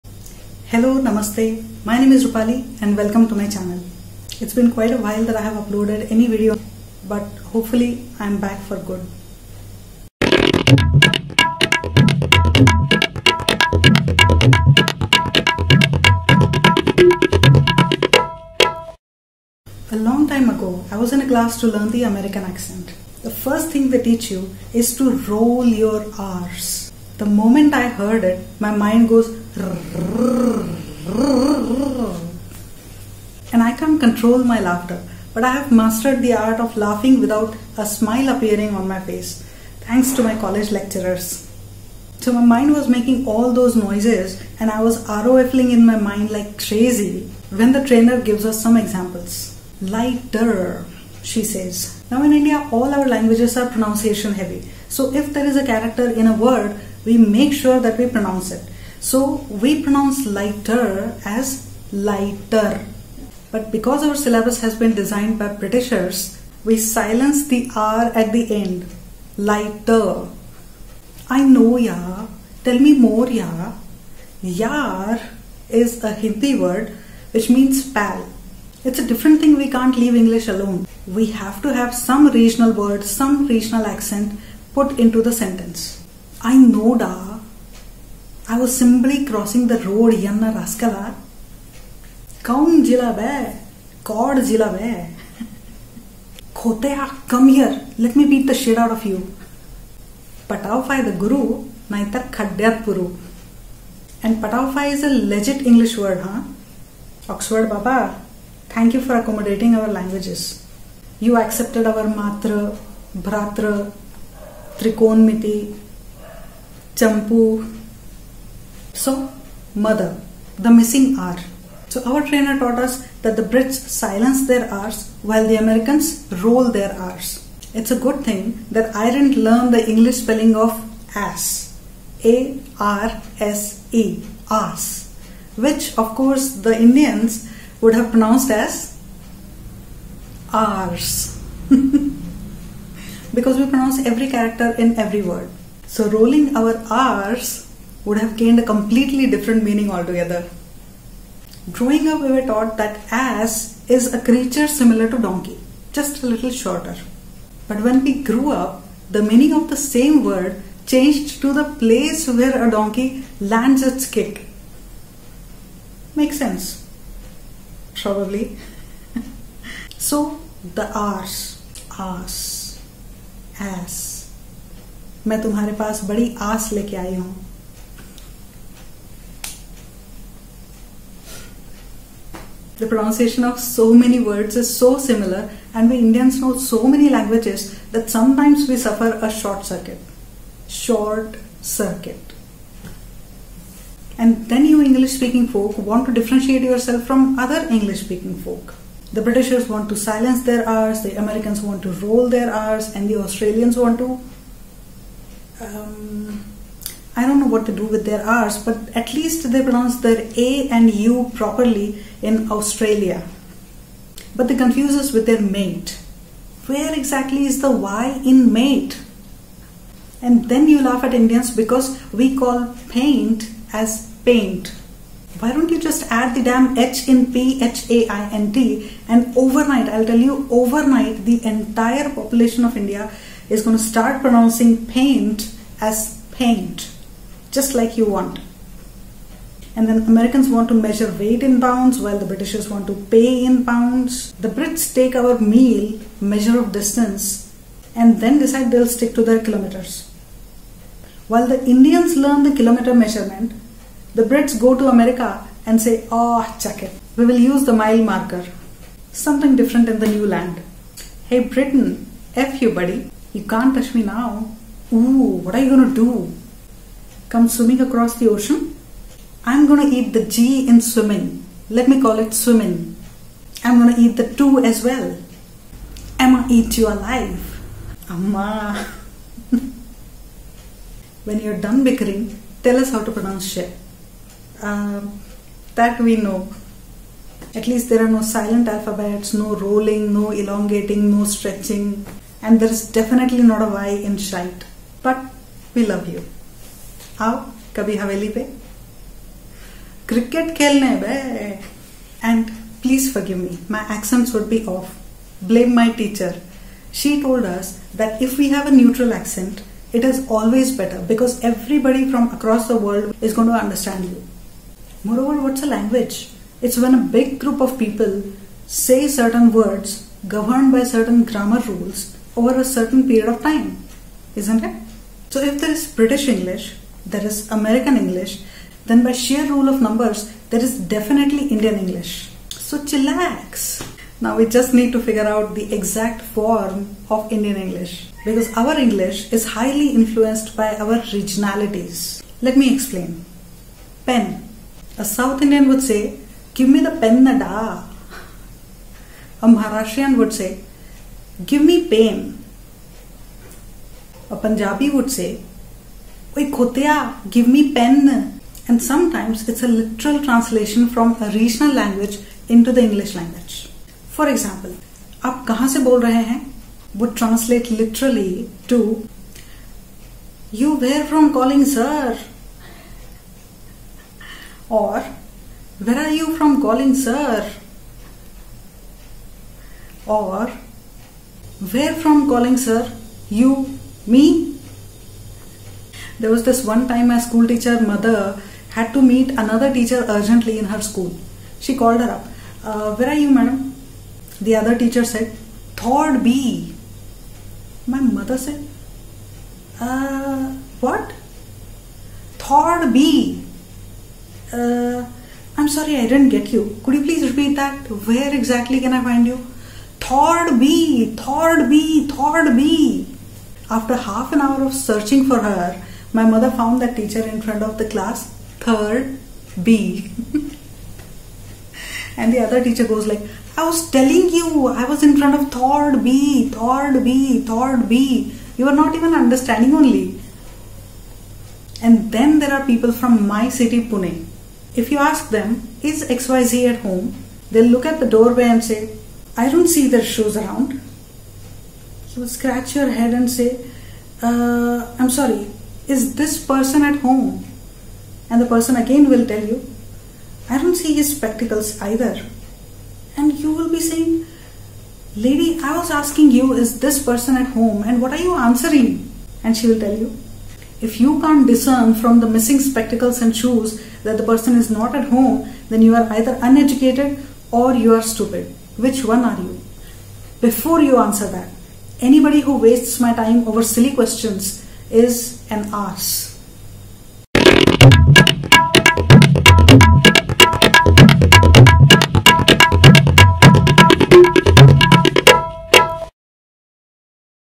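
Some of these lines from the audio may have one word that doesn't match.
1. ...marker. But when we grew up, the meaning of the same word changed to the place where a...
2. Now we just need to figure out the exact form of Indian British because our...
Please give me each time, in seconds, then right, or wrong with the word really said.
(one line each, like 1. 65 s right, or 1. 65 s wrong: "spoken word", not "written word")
1. 156 s wrong: "shorter", not "marker"
2. 334 s wrong: "English", not "British".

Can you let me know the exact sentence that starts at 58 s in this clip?
So we pronounce lighter as lighter but because our syllabus has been designed by Britishers, we silence the R at the end.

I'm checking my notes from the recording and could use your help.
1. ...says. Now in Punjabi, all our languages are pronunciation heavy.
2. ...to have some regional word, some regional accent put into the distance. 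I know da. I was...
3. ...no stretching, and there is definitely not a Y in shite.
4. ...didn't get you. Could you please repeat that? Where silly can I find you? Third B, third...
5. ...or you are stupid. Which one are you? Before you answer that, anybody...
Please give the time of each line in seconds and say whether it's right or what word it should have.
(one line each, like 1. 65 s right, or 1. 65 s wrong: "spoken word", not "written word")
1. 51 s wrong: "India", not "Punjabi"
2. 81 s wrong: "sentence", not "distance"
3. 291 s right
4. 406 s wrong: "exactly", not "silly"
5. 467 s right.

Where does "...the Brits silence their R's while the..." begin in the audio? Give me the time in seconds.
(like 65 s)
123 s.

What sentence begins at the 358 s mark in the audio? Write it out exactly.
And sometimes it's a literal translation from a regional language into the English language.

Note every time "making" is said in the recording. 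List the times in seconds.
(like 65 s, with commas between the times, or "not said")
42 s.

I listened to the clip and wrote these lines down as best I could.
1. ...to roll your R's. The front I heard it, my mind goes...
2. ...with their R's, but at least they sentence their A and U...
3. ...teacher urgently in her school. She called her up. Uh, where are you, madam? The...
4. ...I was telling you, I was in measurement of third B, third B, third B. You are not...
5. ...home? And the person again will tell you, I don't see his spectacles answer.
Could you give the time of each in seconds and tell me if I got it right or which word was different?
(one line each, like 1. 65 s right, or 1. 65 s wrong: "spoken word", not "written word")
1. 24 s wrong: "moment", not "front"
2. 207 s wrong: "pronounce", not "sentence"
3. 389 s right
4. 423 s wrong: "front", not "measurement"
5. 446 s wrong: "either", not "answer".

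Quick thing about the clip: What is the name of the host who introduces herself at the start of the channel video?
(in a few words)
Rupali.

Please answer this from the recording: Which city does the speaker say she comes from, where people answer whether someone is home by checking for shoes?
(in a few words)
Pune.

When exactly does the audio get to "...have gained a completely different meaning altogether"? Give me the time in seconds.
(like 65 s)
148 s.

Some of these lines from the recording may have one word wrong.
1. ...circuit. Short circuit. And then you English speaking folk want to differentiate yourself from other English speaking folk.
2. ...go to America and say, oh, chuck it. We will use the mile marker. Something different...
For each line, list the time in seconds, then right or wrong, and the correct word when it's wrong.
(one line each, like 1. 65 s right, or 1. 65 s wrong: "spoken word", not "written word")
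1. 189 s right
2. 254 s right.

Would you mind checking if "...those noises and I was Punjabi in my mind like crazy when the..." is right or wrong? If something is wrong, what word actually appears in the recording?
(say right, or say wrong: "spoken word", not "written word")
wrong: "ROFling", not "Punjabi".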